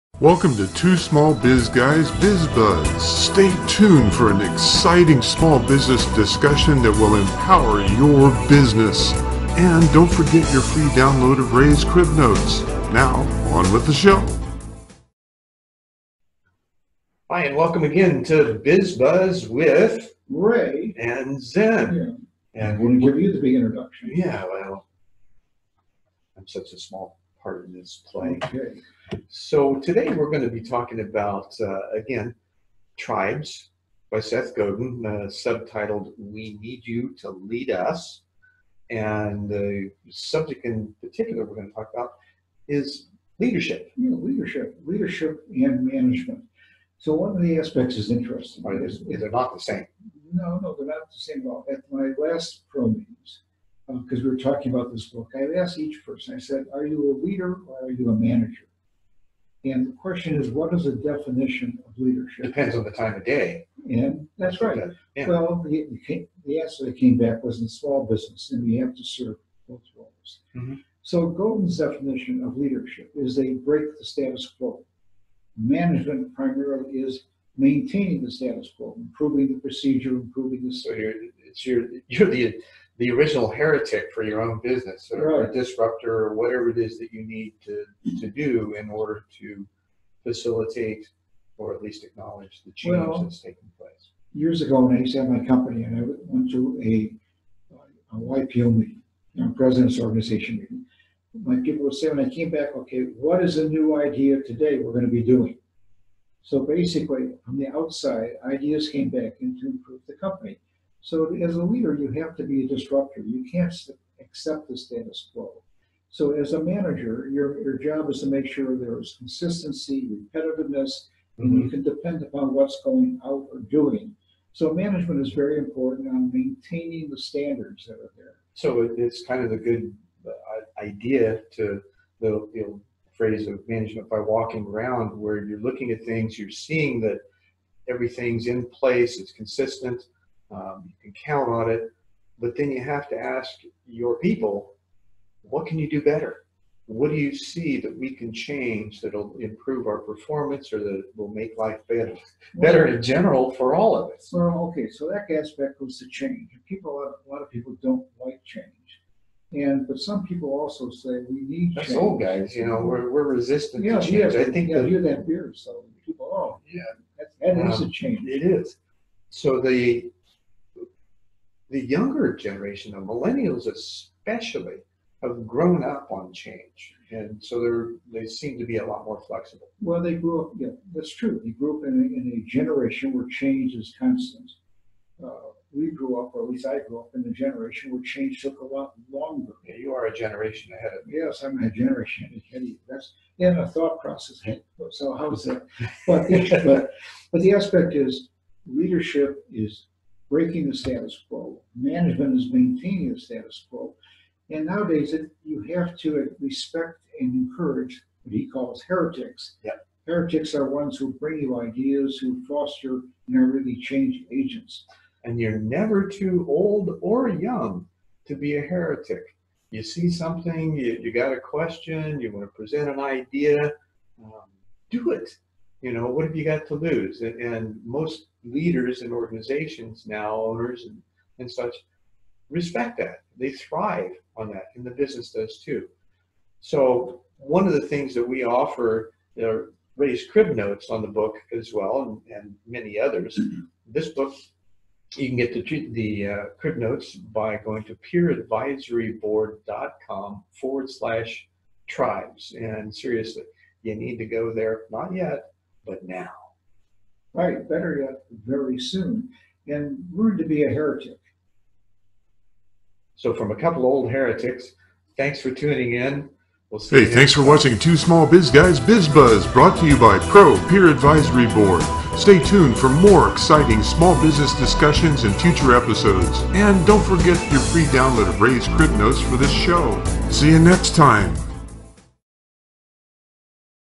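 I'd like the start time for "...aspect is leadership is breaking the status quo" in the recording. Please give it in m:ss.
3:17.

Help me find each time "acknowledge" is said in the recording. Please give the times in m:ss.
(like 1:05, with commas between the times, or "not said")
1:32.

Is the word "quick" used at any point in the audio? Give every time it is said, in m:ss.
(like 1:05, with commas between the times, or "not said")
not said.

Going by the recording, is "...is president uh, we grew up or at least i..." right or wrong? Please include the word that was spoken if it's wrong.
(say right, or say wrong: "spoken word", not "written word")
wrong: "constant", not "president".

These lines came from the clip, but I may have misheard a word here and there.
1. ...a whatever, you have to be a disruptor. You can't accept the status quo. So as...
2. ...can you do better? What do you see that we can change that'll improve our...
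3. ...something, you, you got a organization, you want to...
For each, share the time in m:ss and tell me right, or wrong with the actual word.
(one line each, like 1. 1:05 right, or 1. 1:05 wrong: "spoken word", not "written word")
1. 1:51 wrong: "leader", not "whatever"
2. 2:25 right
3. 3:40 wrong: "question", not "organization".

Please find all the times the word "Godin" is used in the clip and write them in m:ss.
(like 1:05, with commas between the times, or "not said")
0:34, 1:11.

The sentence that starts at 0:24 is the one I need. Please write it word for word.
Yeah, well, I'm such a small part in this play.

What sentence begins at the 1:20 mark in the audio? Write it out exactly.
So you're, it's you're you're the the original heretic for your own business or right.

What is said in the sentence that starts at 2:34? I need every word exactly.
Well, okay, so that aspect was to change.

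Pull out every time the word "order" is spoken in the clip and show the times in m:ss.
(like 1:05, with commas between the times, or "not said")
1:28.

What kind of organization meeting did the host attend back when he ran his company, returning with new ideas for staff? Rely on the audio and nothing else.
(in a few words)
YPO.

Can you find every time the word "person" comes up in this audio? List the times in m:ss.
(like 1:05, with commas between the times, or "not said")
0:56.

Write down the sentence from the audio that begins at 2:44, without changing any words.
Yeah, I think yeah, the, you that beer, so people, oh, yeah, that, that um, is a um, change.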